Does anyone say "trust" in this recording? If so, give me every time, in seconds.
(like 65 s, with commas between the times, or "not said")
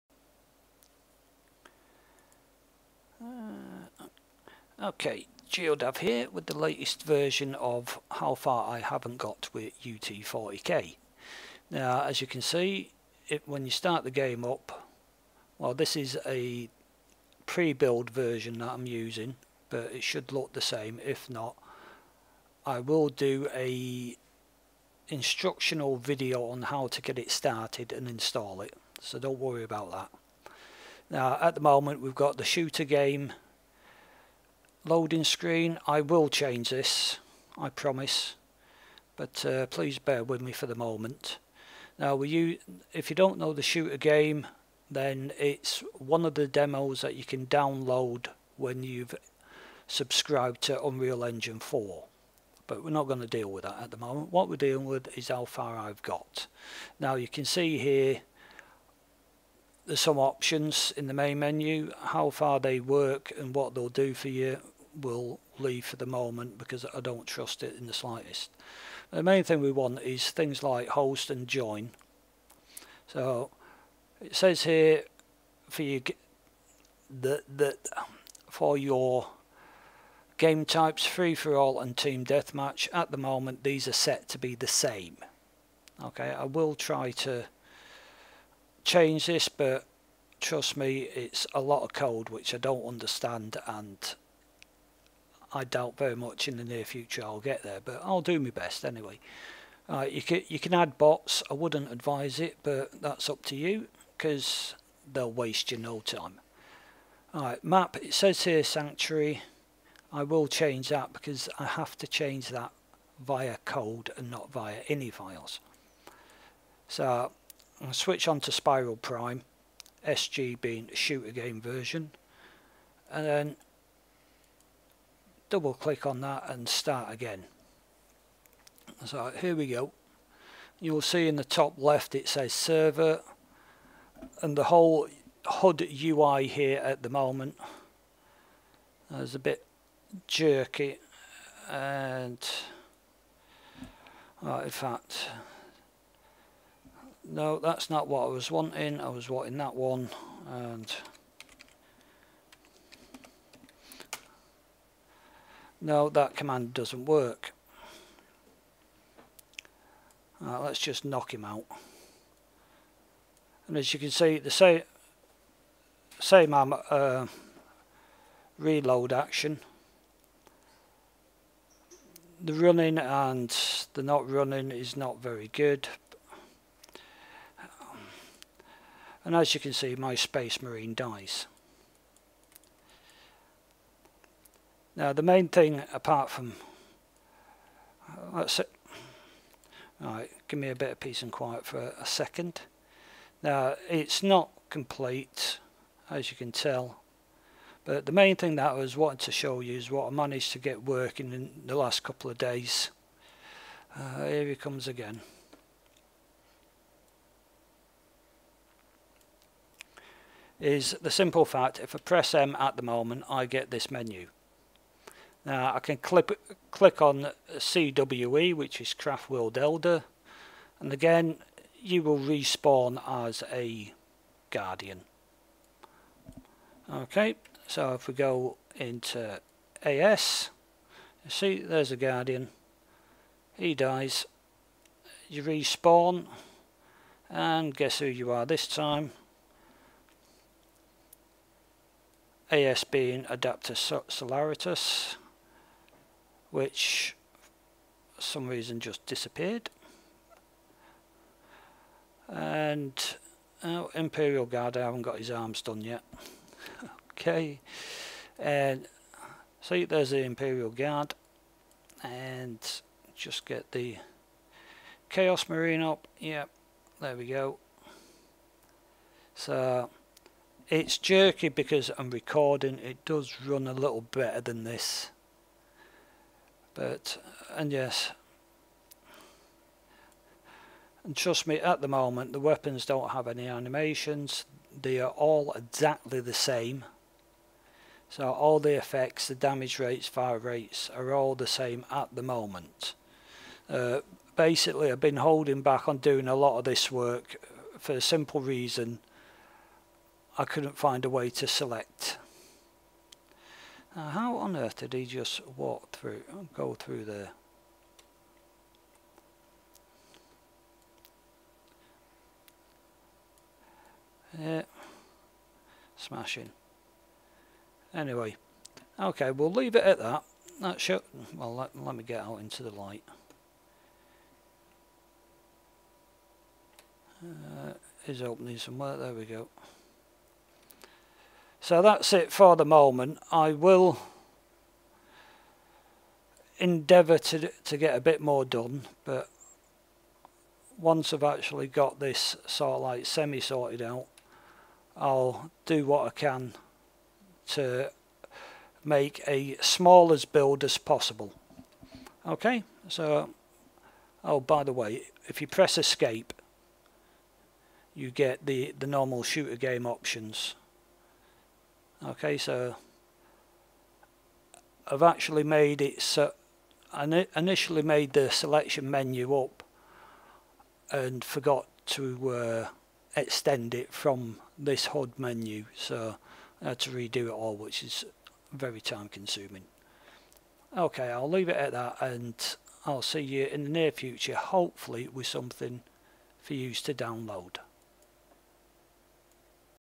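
67 s, 90 s, 281 s.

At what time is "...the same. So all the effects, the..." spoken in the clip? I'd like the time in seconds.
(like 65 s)
286 s.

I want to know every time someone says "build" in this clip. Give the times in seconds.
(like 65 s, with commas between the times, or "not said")
17 s, 350 s.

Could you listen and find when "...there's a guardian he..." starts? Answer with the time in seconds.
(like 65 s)
231 s.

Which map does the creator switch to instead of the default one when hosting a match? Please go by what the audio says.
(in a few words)
Spiral Prime.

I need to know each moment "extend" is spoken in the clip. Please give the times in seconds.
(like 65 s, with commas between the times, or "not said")
373 s.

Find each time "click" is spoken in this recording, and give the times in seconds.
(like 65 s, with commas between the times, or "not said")
125 s, 216 s.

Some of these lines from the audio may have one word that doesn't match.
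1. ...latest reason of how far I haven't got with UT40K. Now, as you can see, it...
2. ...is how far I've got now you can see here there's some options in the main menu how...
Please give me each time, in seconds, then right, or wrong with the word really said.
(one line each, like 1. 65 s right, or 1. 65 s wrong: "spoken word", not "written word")
1. 6 s wrong: "version", not "reason"
2. 55 s right.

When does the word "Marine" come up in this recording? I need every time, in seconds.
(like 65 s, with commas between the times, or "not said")
180 s, 265 s.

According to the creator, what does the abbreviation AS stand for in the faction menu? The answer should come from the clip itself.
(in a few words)
Adeptus Solaritus.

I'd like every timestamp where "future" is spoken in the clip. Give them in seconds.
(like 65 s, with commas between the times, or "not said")
96 s, 383 s.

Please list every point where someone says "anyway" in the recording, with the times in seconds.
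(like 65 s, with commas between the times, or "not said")
98 s, 317 s.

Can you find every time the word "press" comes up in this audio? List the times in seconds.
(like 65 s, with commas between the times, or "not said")
211 s, 355 s.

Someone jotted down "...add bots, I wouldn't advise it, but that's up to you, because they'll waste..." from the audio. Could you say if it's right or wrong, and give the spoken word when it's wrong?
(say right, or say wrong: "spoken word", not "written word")
right.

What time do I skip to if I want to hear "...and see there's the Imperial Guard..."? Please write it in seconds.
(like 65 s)
258 s.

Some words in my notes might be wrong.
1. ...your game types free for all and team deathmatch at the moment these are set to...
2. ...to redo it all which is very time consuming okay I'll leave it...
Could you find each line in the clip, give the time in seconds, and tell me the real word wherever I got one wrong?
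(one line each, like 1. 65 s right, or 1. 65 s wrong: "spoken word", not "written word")
1. 78 s right
2. 376 s right.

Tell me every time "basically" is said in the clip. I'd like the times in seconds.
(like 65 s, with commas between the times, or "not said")
294 s.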